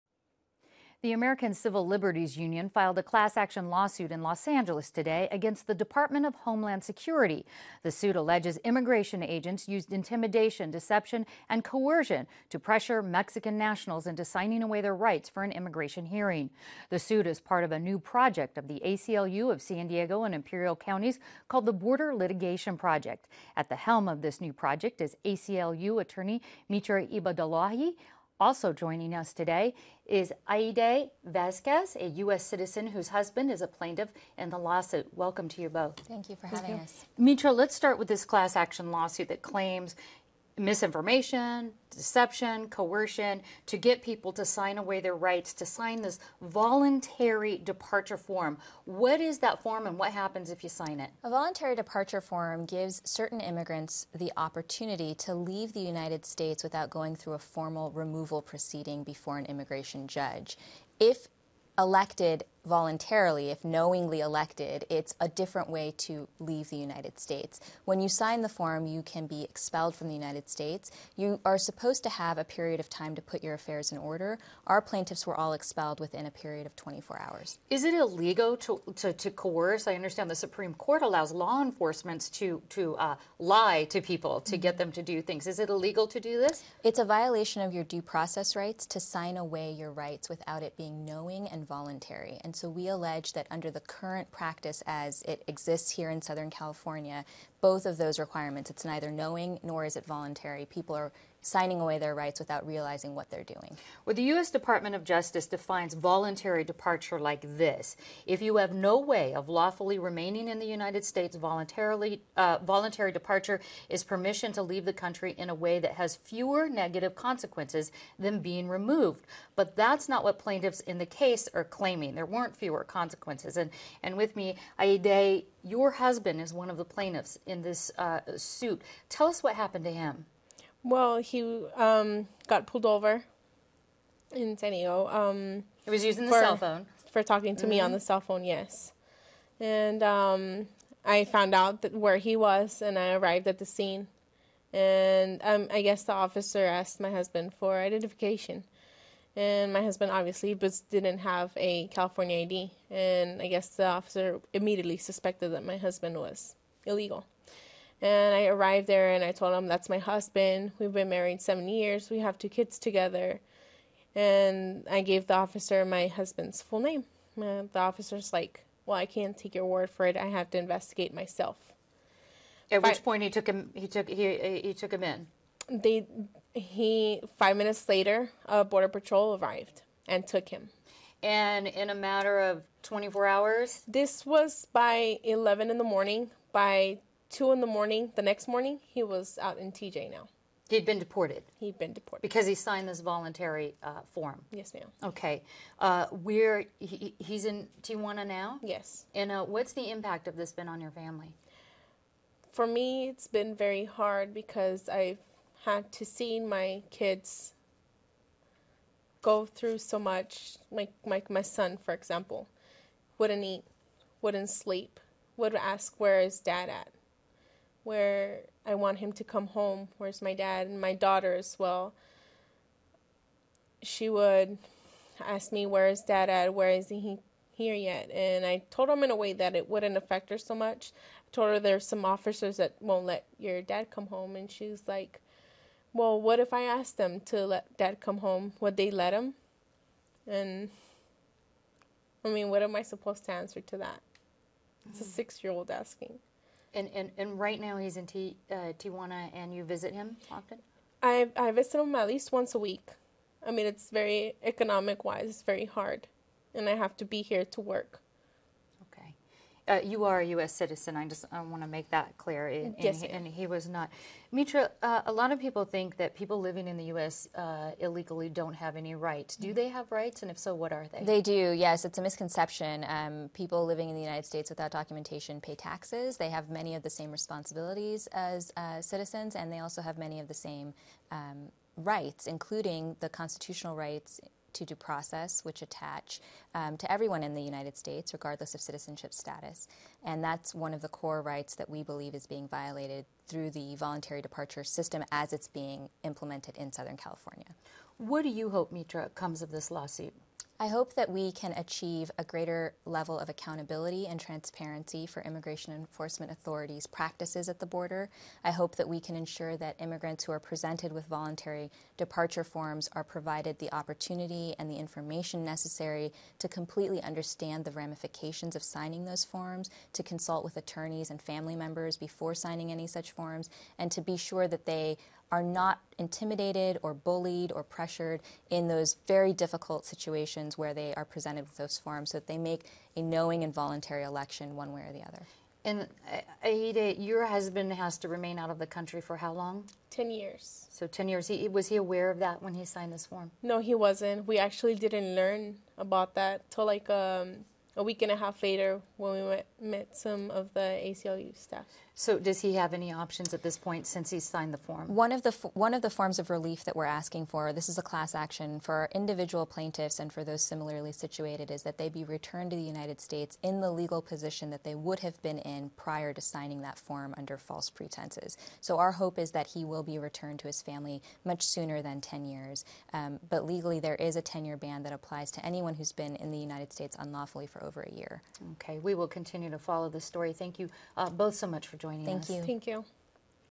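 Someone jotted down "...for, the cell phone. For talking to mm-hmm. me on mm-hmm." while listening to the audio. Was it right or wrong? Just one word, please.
right.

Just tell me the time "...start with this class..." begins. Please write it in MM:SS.
00:37.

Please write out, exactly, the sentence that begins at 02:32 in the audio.
And I guess the officer immediately suspected that my husband was illegal.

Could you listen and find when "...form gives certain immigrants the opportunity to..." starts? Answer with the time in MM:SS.
00:52.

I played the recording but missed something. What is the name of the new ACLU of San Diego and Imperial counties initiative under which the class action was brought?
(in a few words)
Border Litigation Project.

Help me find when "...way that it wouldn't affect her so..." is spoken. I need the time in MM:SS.
03:49.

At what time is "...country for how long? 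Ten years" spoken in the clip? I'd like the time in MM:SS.
05:38.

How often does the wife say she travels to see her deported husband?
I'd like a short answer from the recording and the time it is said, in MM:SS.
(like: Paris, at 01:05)
Once a week, at 04:12.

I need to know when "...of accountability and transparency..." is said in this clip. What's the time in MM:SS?
05:03.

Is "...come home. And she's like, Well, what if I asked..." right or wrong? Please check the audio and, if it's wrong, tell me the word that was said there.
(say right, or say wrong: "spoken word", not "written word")
right.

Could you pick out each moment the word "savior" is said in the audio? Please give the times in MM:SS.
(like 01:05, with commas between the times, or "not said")
not said.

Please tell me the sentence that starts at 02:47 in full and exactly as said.
And uh, the officer's like, Well, I can't take your word for it.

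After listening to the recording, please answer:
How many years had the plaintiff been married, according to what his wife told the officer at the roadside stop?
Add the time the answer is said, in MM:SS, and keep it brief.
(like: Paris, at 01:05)
7, at 02:41.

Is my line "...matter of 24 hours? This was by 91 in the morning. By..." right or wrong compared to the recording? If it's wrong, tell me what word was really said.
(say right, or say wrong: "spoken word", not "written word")
wrong: "11", not "91".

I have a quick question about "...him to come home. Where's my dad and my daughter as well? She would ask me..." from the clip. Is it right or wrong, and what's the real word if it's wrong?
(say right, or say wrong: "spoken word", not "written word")
right.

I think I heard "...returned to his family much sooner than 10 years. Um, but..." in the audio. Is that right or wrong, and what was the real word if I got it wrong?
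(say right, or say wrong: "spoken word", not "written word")
right.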